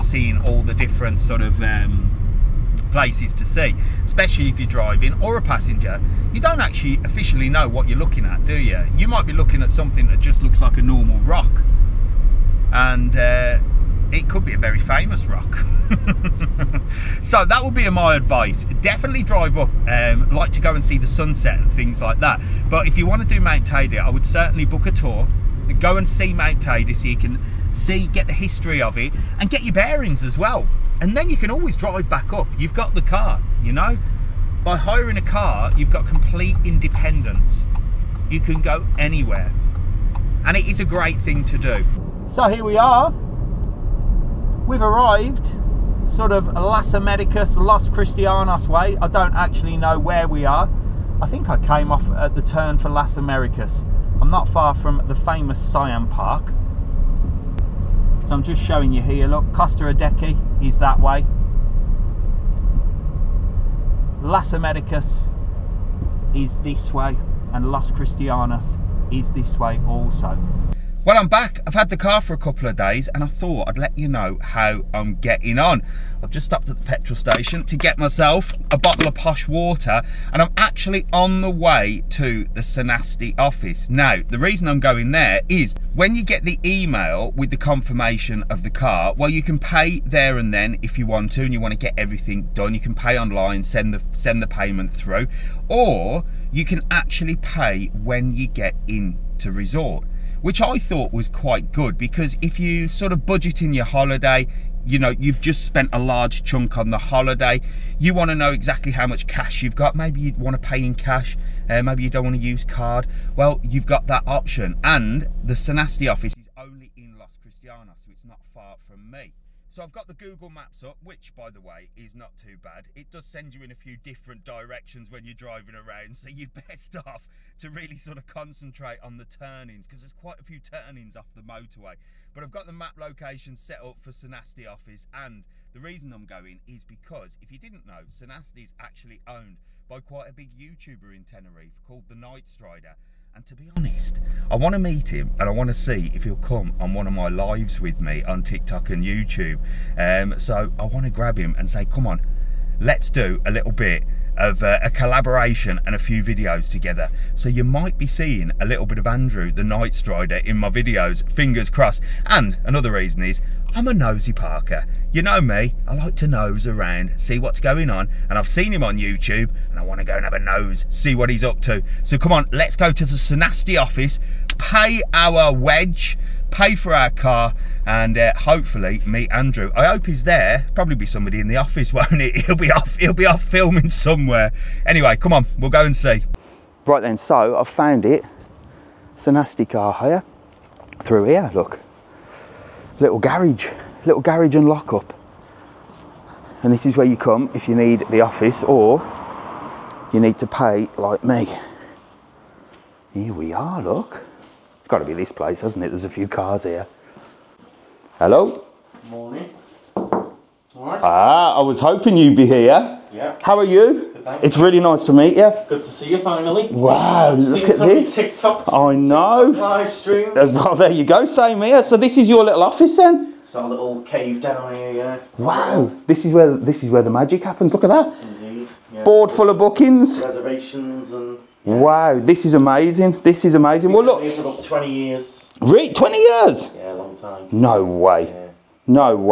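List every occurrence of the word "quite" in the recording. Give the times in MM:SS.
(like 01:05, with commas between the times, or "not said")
01:41, 02:10, 02:19.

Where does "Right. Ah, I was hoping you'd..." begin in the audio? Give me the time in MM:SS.
03:29.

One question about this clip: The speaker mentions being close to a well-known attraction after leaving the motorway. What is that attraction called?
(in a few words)
Siam Park.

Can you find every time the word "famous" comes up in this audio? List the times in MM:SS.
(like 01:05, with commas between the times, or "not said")
00:14, 00:55.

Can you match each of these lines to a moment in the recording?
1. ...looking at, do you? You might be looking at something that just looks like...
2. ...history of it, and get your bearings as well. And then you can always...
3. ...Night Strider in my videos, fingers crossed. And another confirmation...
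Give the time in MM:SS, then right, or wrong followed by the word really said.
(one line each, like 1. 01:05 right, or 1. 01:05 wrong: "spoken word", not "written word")
1. 00:07 right
2. 00:28 right
3. 02:39 wrong: "reason", not "confirmation".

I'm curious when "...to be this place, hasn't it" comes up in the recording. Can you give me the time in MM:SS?
03:24.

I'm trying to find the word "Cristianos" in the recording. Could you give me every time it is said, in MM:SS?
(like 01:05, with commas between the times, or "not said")
00:47, 01:07, 01:57.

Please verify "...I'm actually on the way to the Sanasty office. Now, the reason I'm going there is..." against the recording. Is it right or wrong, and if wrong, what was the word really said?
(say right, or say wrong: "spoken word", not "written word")
right.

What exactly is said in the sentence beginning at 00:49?
I don't actually know where we are.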